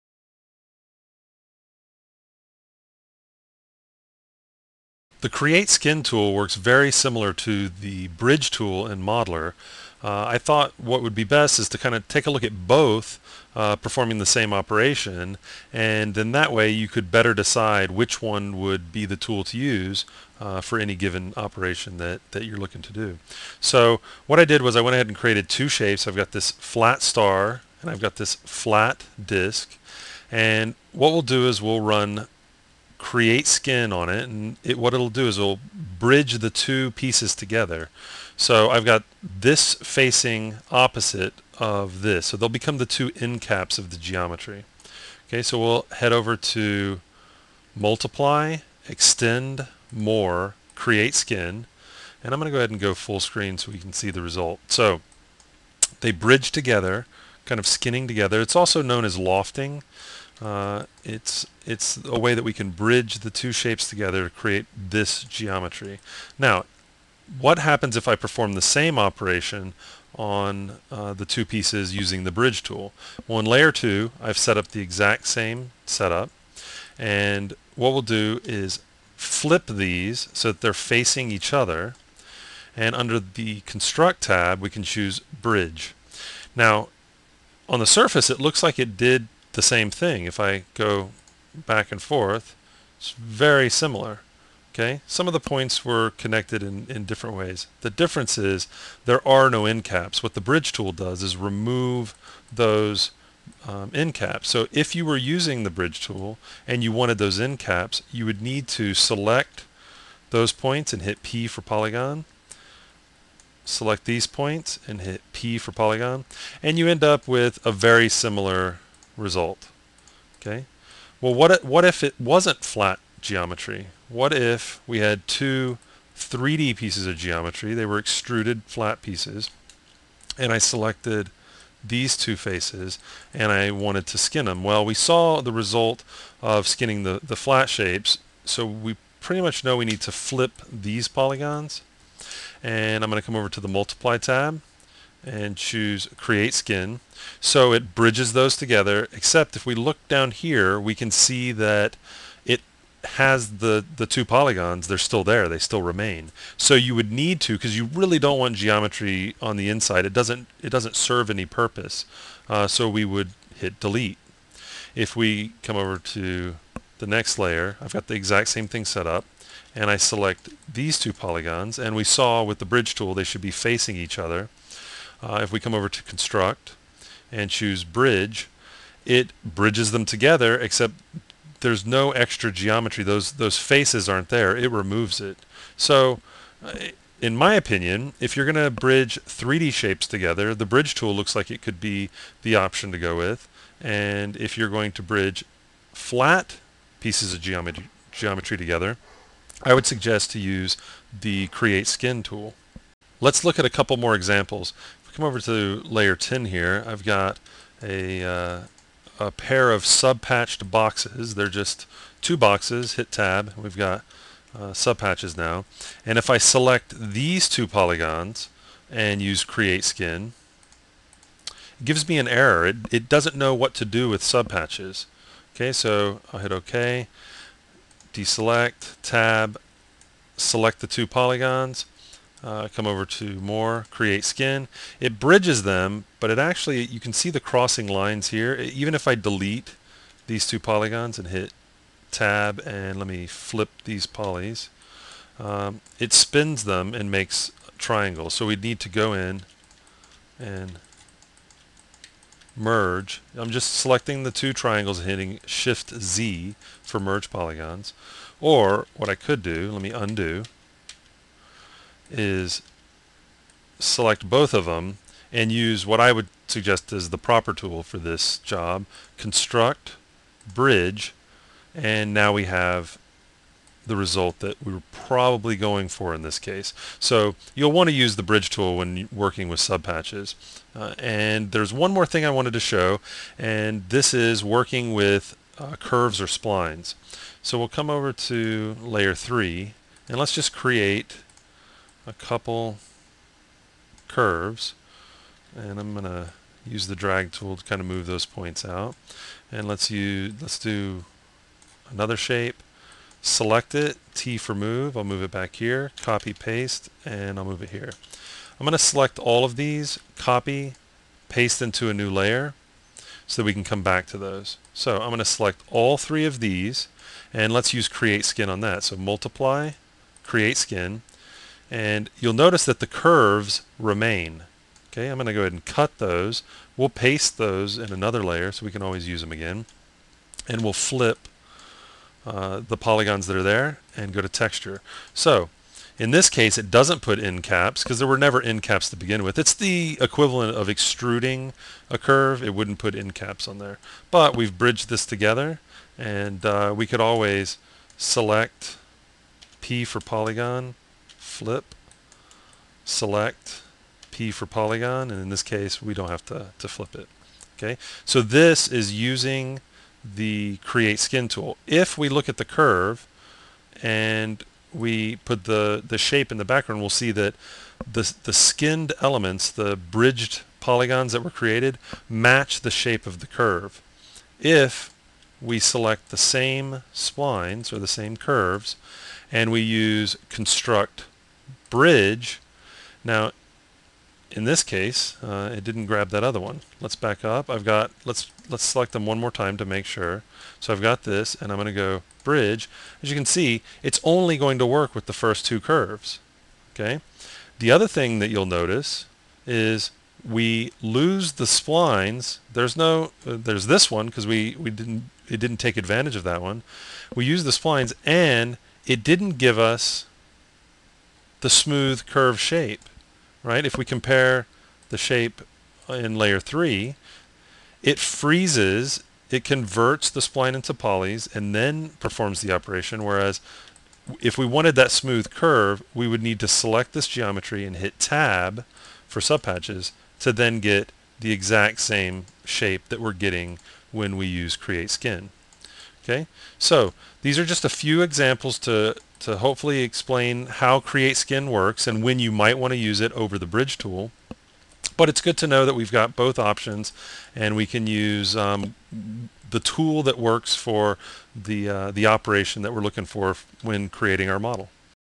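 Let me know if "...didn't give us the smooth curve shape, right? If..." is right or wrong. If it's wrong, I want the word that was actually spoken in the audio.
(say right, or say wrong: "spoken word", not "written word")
right.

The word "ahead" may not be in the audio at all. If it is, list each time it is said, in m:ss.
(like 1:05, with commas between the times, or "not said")
0:24, 0:52, 5:25.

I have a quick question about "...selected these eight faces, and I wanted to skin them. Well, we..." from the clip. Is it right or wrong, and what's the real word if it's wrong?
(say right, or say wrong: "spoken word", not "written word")
wrong: "two", not "eight".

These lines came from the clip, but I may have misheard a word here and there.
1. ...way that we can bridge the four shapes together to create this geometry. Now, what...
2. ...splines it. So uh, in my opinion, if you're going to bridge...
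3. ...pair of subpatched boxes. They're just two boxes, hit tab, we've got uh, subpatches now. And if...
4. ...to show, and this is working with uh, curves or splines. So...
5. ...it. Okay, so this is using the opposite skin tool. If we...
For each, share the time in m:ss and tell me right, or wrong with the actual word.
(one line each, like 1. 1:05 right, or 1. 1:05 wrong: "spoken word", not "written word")
1. 1:02 wrong: "two", not "four"
2. 3:04 wrong: "removes", not "splines"
3. 3:29 right
4. 4:42 right
5. 5:56 wrong: "create", not "opposite".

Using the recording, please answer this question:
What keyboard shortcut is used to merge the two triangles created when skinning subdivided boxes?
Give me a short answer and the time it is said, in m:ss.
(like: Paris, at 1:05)
Shift Z, at 4:15.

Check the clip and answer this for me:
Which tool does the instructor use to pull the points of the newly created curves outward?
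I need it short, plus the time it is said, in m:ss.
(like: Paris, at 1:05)
Drag tool, at 4:56.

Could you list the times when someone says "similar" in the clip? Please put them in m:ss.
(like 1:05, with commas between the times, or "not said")
0:06, 1:33, 1:58.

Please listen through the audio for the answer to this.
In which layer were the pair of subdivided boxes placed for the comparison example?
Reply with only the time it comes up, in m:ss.
3:25.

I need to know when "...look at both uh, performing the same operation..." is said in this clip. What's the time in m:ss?
0:12.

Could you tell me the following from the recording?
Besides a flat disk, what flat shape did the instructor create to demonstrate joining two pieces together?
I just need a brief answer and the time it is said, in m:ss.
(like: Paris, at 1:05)
Star, at 0:26.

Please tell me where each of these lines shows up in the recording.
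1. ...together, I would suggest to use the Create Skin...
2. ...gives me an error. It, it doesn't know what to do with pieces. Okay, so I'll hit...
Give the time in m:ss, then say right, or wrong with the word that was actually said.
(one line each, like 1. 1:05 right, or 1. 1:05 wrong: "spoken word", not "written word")
1. 3:18 right
2. 3:41 wrong: "subpatches", not "pieces".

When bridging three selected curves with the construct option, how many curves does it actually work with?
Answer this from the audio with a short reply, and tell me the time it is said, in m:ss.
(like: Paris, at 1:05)
2, at 6:35.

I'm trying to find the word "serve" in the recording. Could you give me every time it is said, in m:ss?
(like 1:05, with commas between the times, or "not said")
2:40.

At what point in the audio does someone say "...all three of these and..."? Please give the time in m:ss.
5:15.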